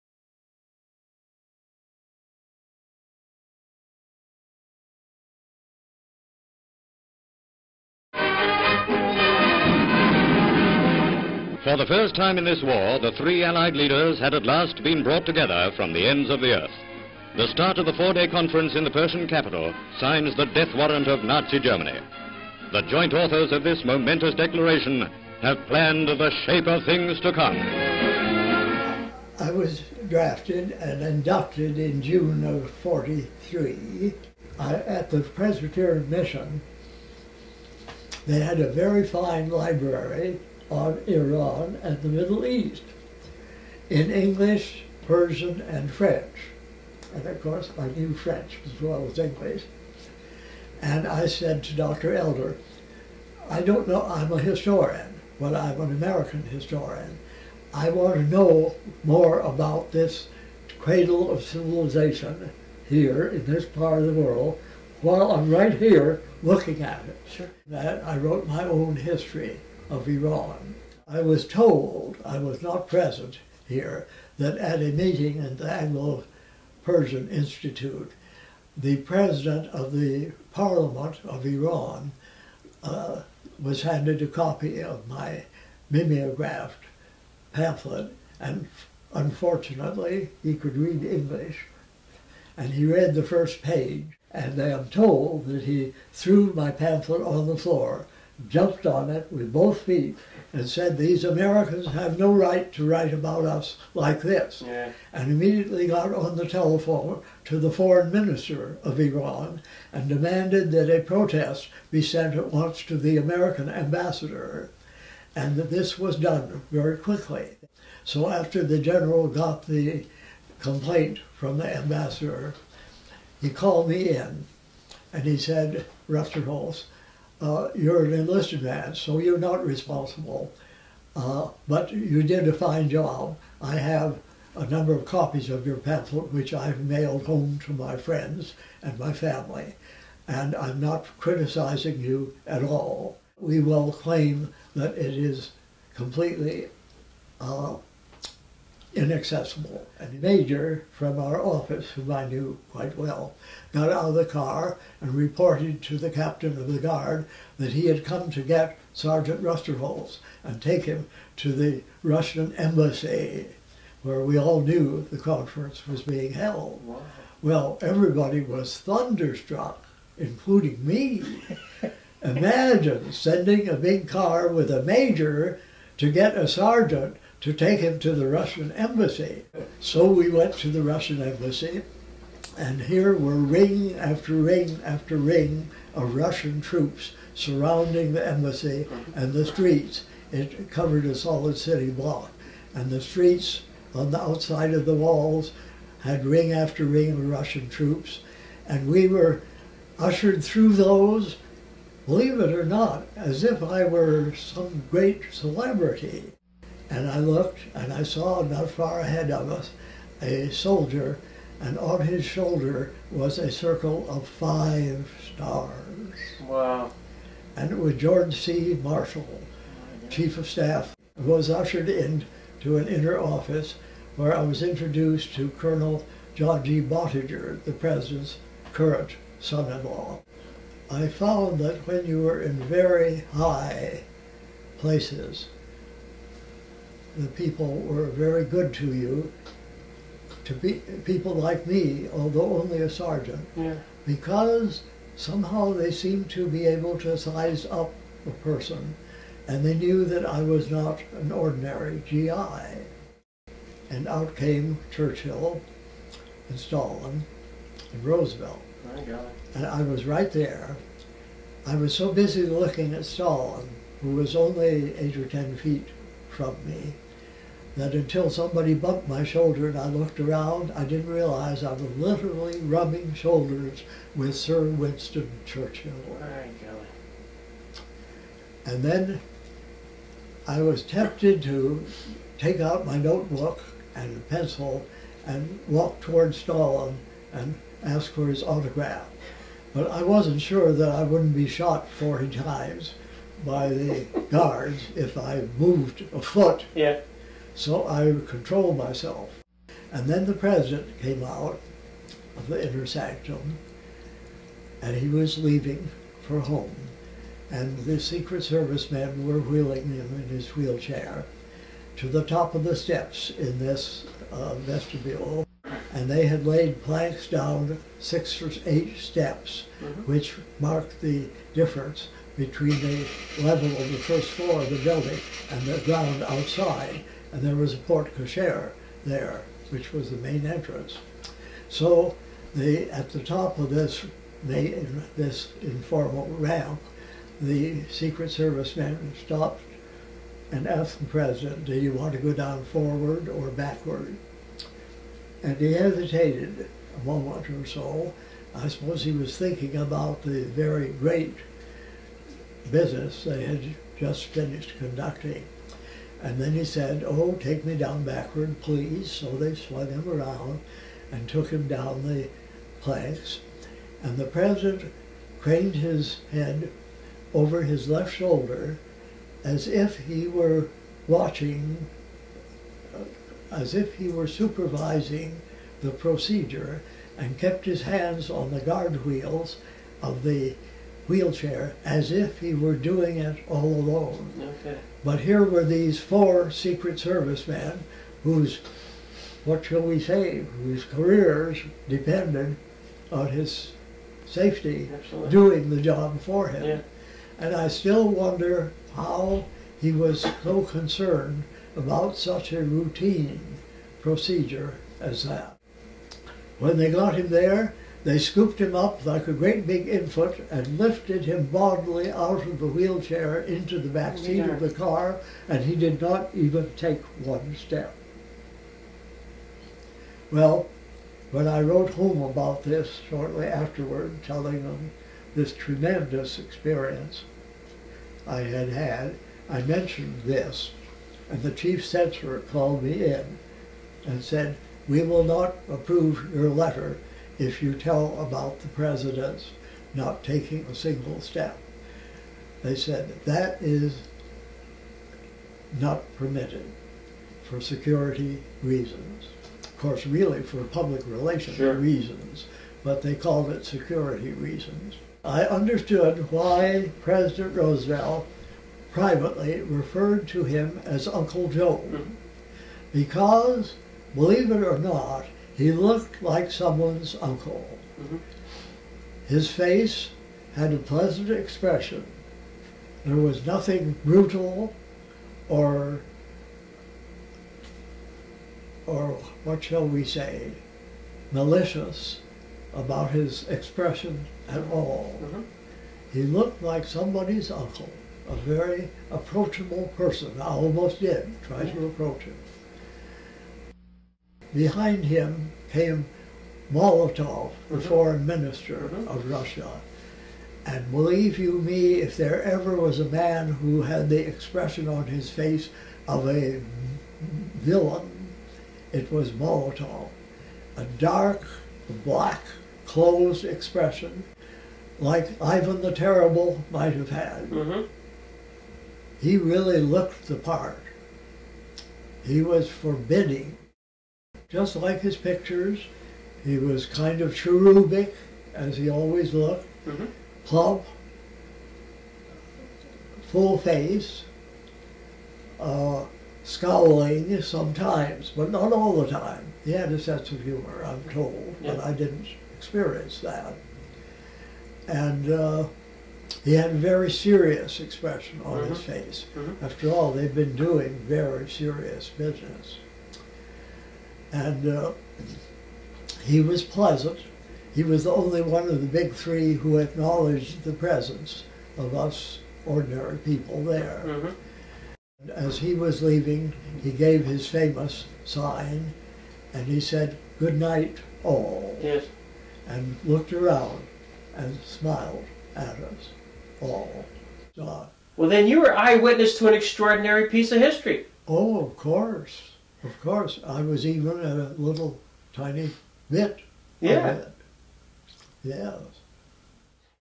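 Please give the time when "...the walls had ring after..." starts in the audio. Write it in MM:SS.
03:14.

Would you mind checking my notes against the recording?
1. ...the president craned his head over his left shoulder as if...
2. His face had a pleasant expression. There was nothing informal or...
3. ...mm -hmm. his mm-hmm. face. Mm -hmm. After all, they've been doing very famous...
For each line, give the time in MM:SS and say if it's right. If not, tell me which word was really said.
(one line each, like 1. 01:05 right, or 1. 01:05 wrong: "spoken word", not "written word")
1. 06:04 right
2. 07:49 wrong: "brutal", not "informal"
3. 09:08 wrong: "serious", not "famous".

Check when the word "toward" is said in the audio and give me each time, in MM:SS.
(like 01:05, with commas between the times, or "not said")
04:46.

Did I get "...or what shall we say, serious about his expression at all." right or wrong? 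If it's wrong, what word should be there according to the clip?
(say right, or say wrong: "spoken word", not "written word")
wrong: "malicious", not "serious".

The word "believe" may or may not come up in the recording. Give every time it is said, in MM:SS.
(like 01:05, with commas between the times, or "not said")
03:22, 07:44, 08:20.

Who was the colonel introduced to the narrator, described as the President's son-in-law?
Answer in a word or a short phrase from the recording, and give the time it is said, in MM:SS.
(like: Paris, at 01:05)
John G. Boettiger, at 03:46.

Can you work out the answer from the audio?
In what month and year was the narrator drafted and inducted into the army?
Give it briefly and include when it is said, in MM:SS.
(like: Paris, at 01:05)
June 1943, at 00:32.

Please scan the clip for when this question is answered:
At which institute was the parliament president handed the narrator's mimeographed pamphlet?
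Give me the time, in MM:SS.
01:15.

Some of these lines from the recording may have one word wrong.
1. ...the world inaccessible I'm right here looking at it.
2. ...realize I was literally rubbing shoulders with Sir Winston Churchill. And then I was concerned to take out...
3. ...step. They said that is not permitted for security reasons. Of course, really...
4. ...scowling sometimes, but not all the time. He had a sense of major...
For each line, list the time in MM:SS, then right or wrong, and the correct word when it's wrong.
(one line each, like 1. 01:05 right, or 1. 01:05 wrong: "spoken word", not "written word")
1. 01:04 wrong: "while", not "inaccessible"
2. 04:31 wrong: "tempted", not "concerned"
3. 07:21 right
4. 08:56 wrong: "humor", not "major".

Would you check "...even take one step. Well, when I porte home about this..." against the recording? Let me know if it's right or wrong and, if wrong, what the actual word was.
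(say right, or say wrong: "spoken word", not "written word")
wrong: "wrote", not "porte".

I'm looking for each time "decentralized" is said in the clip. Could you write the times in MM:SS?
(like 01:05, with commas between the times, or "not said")
not said.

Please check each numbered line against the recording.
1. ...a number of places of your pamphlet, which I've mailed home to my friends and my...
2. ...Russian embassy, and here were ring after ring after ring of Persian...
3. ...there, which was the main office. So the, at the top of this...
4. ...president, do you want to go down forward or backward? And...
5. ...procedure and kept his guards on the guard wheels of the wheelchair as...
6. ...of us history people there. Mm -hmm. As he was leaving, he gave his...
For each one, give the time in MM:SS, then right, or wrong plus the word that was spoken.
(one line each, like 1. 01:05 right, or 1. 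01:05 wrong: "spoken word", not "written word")
1. 02:14 wrong: "copies", not "places"
2. 03:00 wrong: "Russian", not "Persian"
3. 05:29 wrong: "entrance", not "office"
4. 05:41 right
5. 06:15 wrong: "hands", not "guards"
6. 09:21 wrong: "ordinary", not "history".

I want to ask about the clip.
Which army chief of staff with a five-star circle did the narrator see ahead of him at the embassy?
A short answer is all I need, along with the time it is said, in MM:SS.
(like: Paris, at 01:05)
George C. Marshall, at 03:37.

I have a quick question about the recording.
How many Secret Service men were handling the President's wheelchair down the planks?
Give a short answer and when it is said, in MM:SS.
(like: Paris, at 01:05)
4, at 06:25.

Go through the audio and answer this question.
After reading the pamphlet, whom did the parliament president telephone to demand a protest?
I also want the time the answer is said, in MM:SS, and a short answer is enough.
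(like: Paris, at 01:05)
Foreign minister of Iran, at 01:47.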